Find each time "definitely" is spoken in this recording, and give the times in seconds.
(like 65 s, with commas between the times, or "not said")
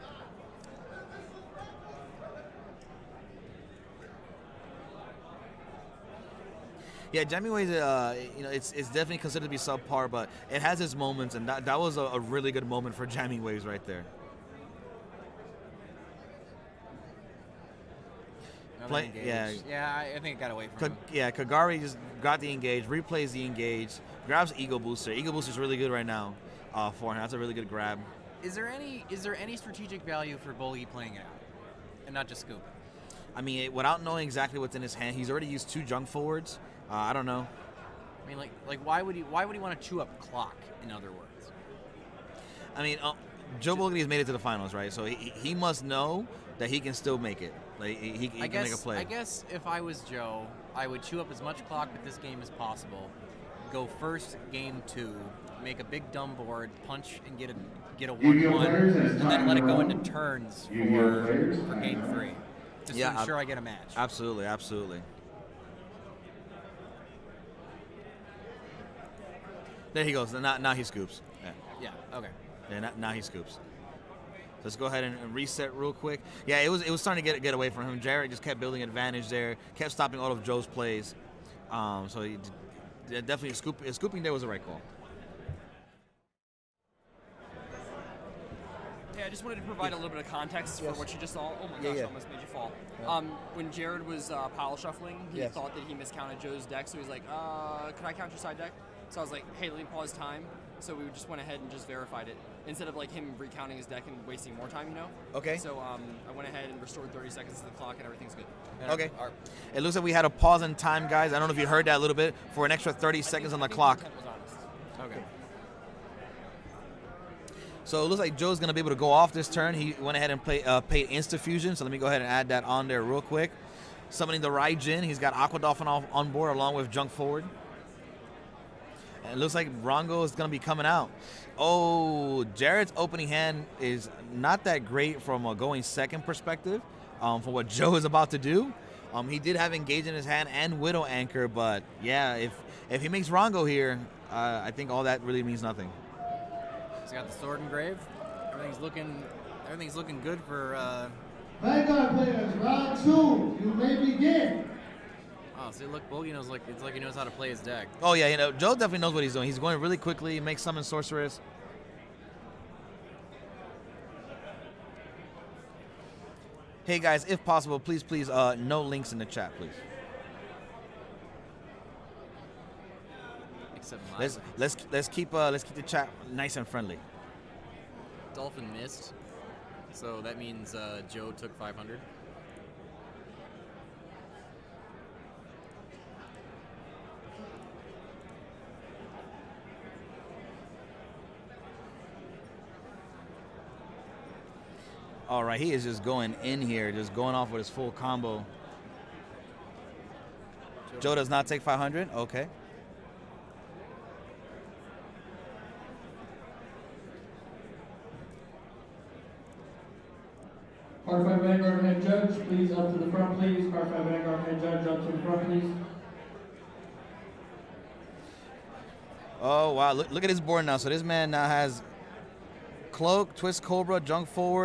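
8 s, 83 s, 158 s.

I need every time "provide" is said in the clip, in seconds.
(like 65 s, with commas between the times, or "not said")
89 s.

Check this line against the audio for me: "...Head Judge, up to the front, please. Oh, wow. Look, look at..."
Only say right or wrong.
right.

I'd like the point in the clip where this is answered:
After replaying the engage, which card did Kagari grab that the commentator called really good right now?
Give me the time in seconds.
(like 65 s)
24 s.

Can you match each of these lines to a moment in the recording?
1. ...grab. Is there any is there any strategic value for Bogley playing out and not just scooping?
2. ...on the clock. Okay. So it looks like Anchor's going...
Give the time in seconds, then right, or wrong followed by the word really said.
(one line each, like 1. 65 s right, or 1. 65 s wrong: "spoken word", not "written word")
1. 27 s right
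2. 113 s wrong: "Joe", not "Anchor".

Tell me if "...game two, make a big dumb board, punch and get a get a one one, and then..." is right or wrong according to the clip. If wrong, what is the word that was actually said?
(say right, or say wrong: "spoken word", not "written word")
right.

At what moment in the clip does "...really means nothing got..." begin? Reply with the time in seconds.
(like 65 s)
145 s.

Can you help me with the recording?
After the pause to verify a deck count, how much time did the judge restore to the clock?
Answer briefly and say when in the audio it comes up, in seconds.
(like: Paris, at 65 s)
30 seconds, at 107 s.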